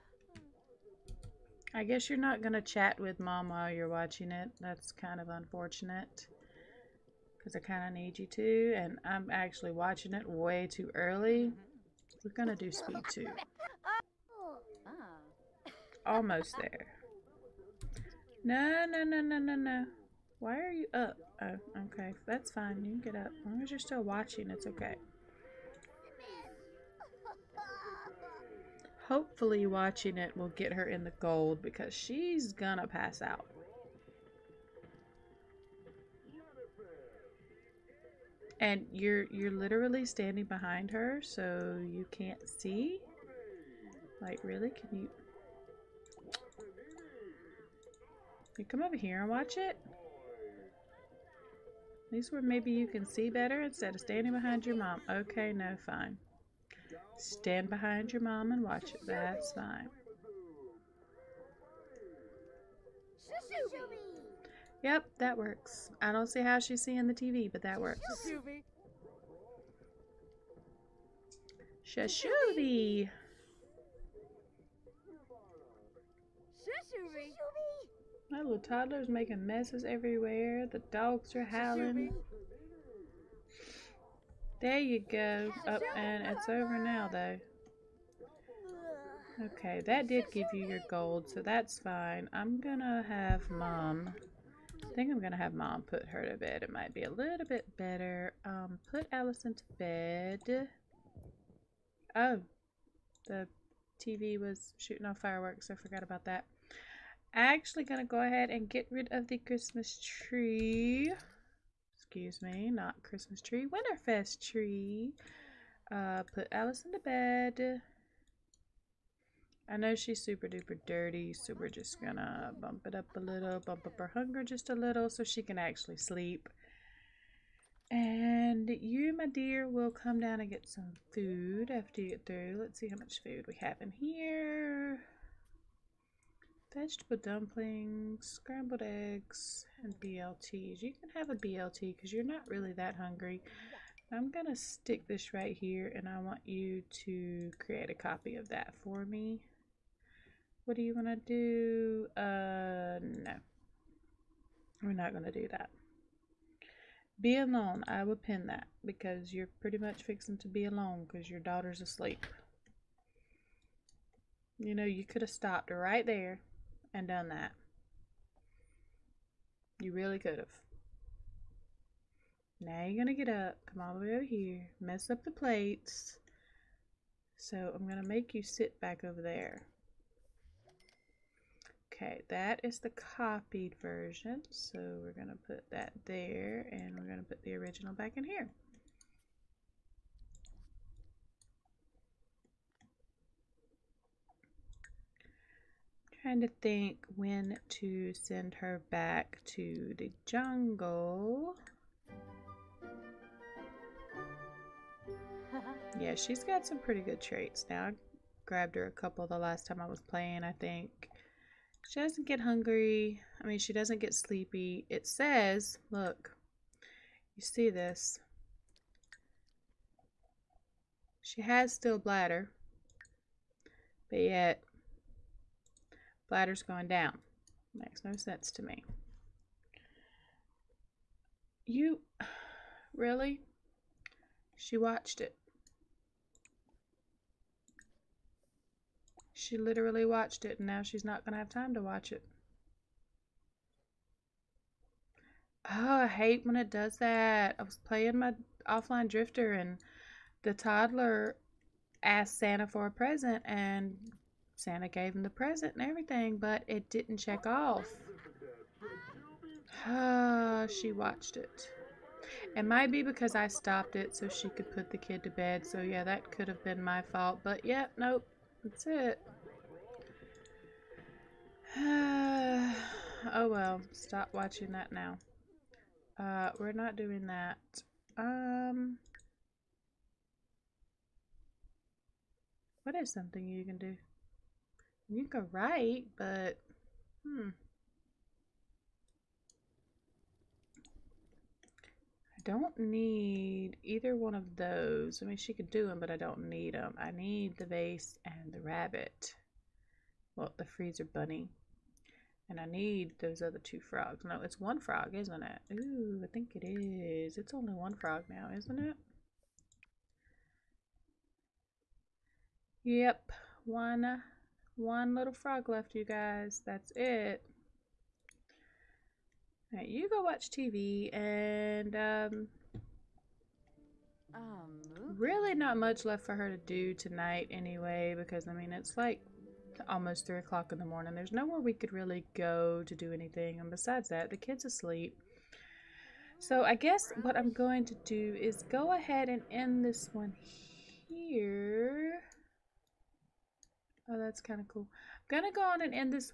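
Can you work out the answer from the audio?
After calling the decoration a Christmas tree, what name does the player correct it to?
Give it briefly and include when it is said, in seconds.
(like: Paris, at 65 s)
Winterfest tree, at 113 s.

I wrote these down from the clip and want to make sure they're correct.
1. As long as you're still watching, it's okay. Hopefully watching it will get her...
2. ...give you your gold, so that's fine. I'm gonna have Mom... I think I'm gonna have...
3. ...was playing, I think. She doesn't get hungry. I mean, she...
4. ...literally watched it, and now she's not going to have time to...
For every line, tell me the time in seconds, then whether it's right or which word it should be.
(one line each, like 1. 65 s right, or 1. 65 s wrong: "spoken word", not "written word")
1. 23 s right
2. 90 s right
3. 209 s right
4. 239 s right.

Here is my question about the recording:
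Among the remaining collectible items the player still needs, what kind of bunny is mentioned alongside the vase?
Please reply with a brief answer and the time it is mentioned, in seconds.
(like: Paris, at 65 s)
freezer bunny, at 300 s.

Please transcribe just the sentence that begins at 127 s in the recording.
And you, my dear, will come down and get some food after you get through.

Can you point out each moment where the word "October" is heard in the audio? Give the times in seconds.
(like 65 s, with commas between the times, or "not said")
not said.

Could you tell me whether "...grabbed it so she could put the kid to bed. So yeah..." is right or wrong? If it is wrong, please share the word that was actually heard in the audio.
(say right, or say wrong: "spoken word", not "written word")
wrong: "stopped", not "grabbed".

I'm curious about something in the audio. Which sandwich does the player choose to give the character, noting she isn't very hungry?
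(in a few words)
BLT.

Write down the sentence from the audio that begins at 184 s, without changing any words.
So we're going to put that there and we're going to put the original back in here.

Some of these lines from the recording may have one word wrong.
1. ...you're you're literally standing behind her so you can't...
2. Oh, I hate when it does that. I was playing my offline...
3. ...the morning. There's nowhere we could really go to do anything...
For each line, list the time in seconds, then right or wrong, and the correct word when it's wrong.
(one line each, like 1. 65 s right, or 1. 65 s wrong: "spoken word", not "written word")
1. 38 s right
2. 245 s right
3. 330 s right.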